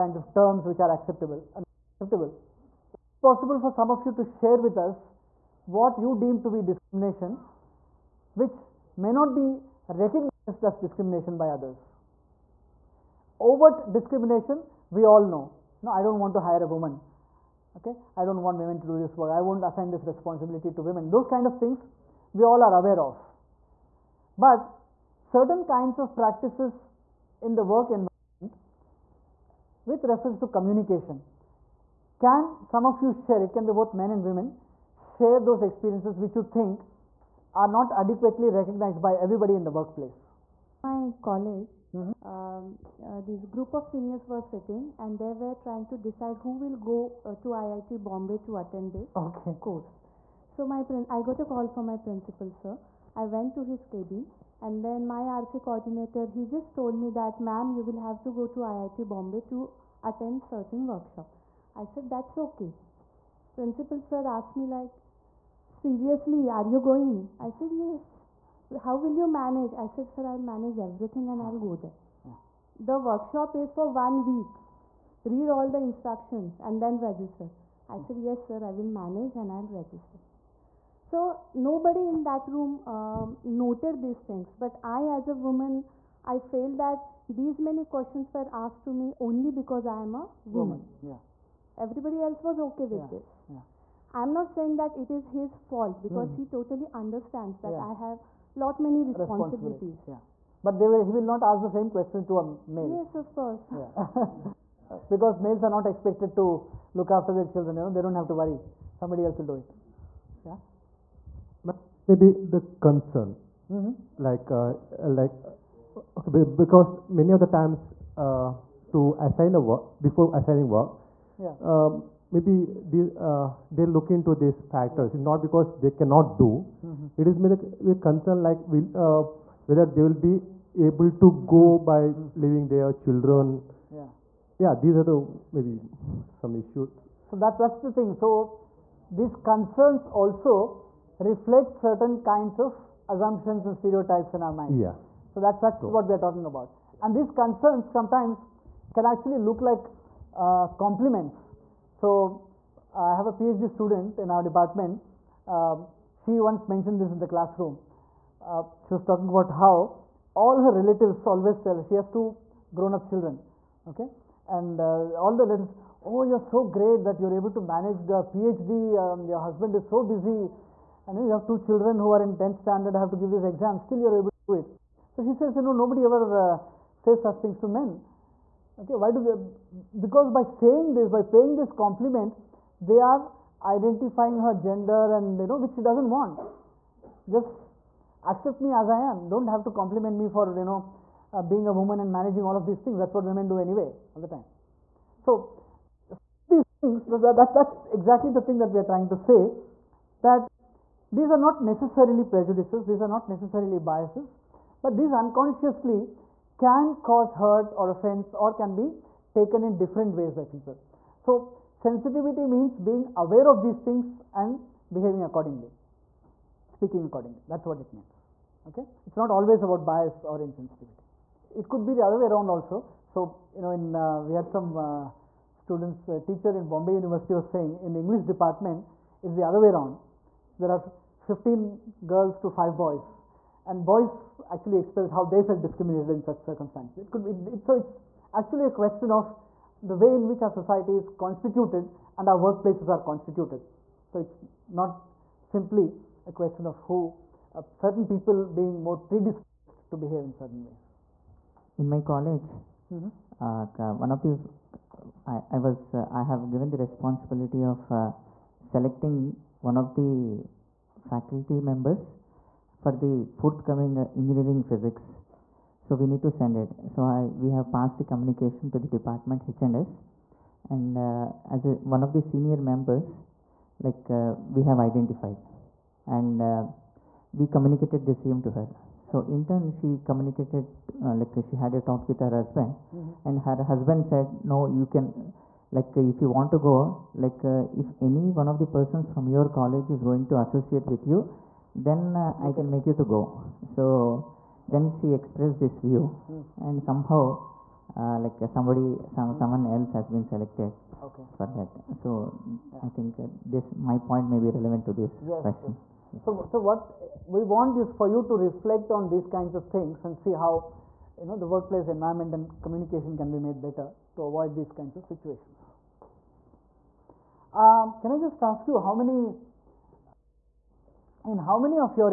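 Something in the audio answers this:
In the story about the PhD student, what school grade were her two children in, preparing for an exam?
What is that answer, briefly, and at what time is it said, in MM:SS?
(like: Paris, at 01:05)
10th standard, at 02:52.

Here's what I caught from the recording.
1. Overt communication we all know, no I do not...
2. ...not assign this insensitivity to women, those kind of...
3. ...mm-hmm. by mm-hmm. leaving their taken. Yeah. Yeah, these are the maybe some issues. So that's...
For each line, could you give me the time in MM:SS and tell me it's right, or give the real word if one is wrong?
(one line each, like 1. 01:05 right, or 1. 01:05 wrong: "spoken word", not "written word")
1. 00:13 wrong: "discrimination", not "communication"
2. 00:19 wrong: "responsibility", not "insensitivity"
3. 02:11 wrong: "children", not "taken".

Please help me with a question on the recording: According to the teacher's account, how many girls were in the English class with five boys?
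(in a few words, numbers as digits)
15.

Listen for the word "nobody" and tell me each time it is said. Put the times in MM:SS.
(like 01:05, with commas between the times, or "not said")
01:21, 02:55.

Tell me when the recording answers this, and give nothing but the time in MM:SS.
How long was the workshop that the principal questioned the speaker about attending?
01:13.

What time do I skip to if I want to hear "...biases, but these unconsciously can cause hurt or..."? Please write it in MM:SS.
03:23.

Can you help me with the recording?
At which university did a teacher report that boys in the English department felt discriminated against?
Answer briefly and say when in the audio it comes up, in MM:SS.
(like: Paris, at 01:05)
Bombay University, at 03:46.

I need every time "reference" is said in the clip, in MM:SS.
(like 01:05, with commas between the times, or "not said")
00:30.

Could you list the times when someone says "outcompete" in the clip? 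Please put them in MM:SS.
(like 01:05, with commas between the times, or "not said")
not said.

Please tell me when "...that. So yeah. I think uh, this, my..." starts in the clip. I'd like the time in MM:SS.
05:01.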